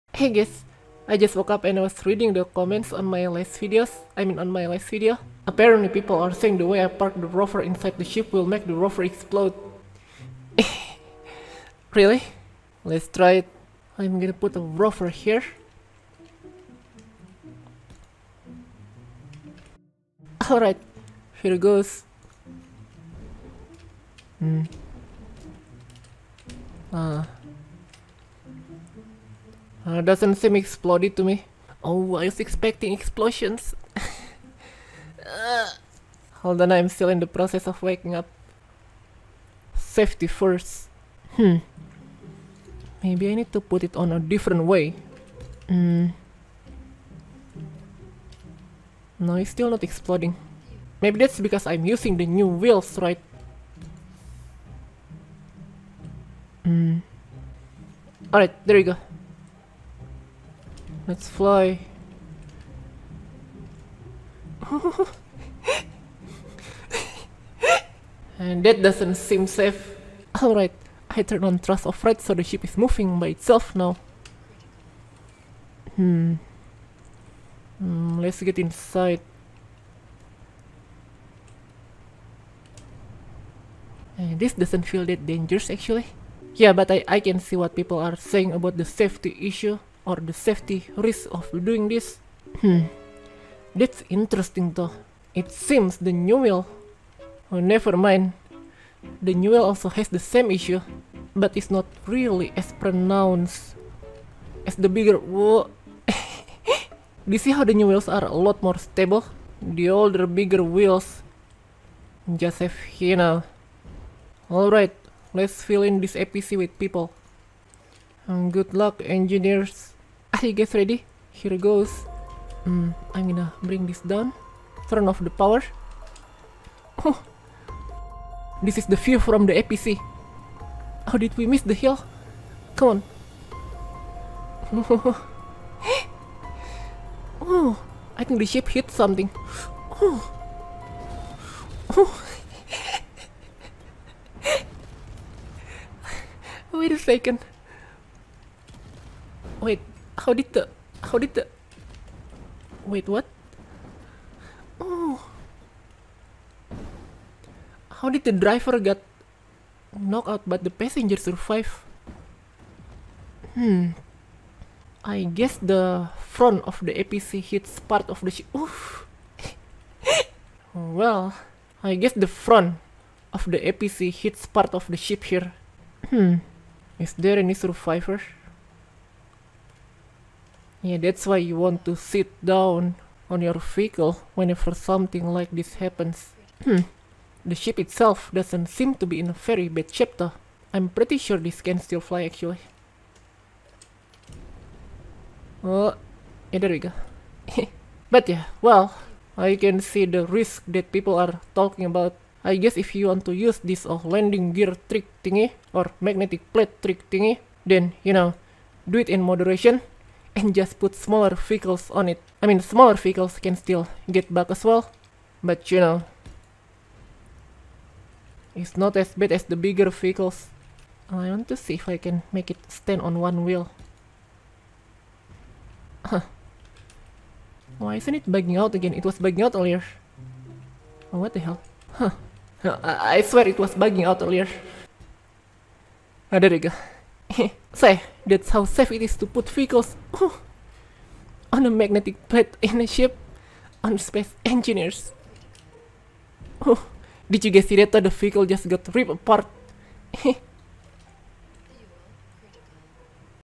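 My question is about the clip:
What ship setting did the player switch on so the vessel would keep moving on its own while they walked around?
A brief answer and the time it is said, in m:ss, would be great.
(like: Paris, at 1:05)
Thrust override, at 1:11.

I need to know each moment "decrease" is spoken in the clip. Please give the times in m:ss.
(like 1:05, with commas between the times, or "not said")
not said.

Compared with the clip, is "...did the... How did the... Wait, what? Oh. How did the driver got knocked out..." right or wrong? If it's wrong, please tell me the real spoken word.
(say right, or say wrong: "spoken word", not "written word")
right.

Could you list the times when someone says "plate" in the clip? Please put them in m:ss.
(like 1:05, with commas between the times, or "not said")
3:26, 4:02.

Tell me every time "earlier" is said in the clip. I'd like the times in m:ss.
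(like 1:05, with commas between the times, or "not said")
3:49, 3:54.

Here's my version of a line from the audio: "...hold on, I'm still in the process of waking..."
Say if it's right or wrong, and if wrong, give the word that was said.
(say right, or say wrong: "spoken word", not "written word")
right.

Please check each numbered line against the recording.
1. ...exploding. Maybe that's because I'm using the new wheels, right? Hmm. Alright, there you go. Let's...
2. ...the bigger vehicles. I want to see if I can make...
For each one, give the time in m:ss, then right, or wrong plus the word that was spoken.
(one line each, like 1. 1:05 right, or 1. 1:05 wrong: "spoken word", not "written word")
1. 0:49 right
2. 3:39 right.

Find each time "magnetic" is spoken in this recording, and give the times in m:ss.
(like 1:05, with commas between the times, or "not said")
3:26, 4:01.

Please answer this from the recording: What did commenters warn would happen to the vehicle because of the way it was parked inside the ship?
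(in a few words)
Explode.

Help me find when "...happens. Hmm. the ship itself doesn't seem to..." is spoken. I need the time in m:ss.
3:05.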